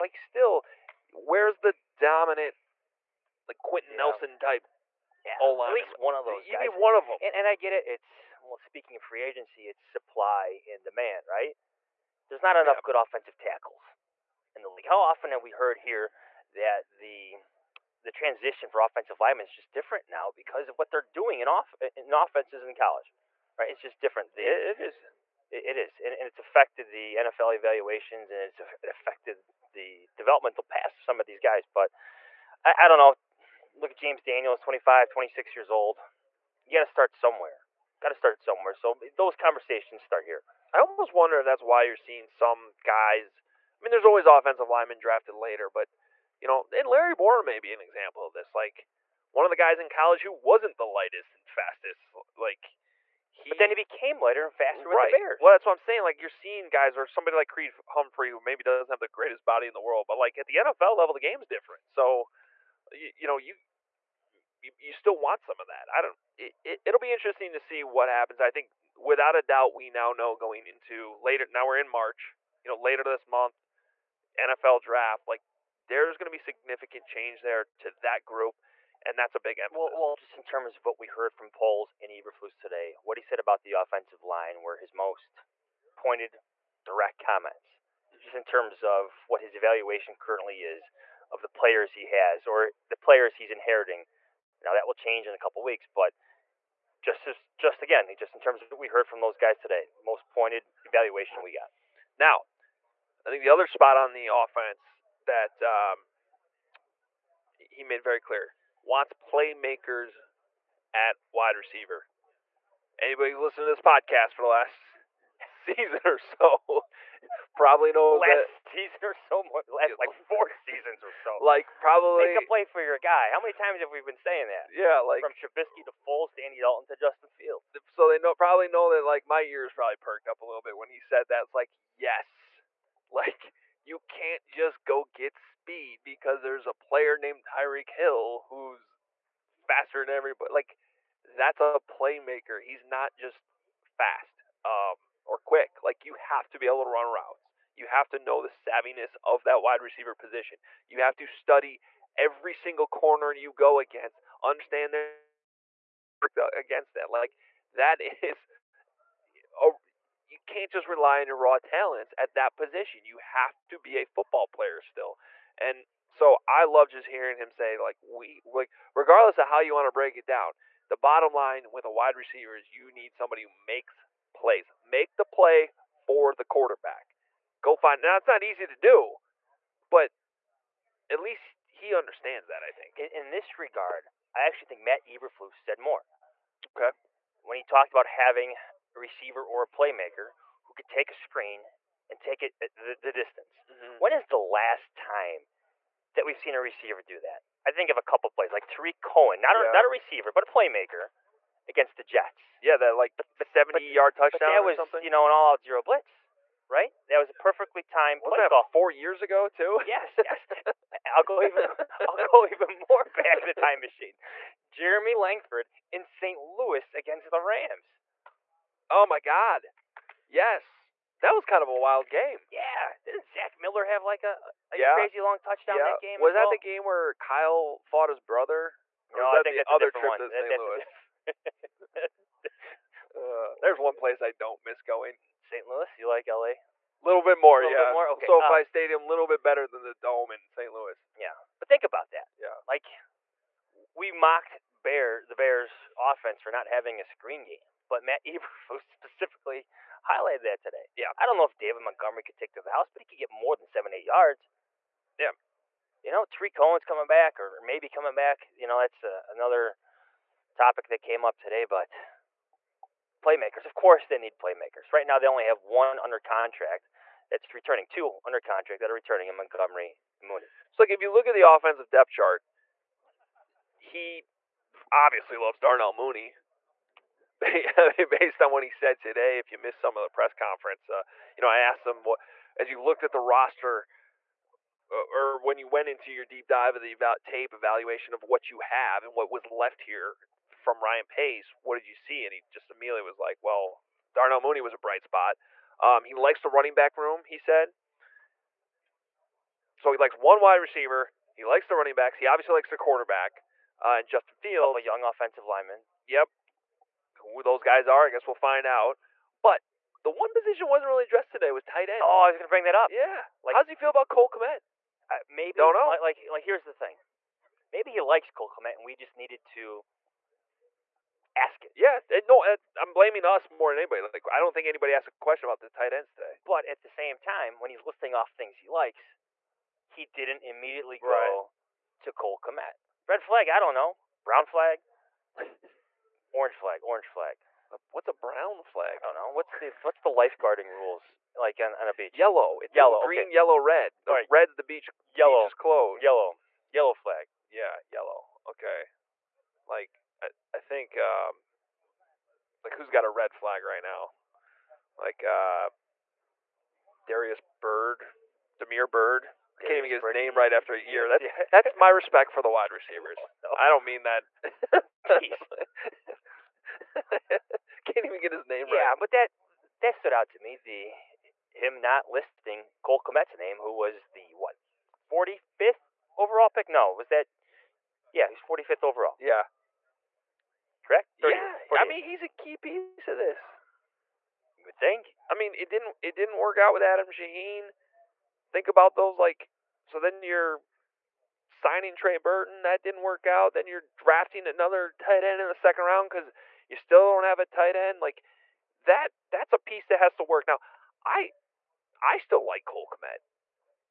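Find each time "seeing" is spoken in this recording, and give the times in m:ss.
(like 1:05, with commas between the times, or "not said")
0:41, 0:56.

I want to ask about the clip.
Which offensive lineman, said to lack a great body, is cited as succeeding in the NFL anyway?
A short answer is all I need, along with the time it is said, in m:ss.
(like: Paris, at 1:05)
Creed Humphrey, at 0:57.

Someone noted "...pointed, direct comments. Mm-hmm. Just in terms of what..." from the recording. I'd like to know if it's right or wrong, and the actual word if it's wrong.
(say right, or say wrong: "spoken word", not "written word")
right.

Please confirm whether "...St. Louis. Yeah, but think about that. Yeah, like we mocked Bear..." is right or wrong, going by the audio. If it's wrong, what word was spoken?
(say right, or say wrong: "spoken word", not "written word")
right.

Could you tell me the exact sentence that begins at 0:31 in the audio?
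But I, I don't know look at James Daniels, 25, 26 years old.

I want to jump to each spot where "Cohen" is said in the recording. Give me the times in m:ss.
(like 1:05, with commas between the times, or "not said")
3:19, 4:16.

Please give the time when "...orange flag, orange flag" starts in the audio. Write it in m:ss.
5:36.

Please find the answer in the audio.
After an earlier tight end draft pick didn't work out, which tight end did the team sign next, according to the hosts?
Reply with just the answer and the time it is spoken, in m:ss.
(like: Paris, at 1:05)
Trey Burton, at 6:31.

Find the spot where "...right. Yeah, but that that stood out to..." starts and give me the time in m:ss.
6:08.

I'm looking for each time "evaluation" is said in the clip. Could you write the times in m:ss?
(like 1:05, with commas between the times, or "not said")
0:27, 1:29, 1:40, 4:47.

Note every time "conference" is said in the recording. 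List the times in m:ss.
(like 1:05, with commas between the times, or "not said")
4:40.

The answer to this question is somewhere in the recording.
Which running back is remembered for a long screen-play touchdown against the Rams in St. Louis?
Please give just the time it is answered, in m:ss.
3:34.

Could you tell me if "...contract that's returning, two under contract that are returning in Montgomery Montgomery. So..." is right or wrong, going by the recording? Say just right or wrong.
wrong.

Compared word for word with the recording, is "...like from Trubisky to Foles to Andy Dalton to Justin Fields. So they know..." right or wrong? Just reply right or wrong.
right.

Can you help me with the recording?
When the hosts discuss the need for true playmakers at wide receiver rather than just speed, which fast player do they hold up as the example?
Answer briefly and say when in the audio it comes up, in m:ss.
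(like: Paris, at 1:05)
Tyreek Hill, at 2:17.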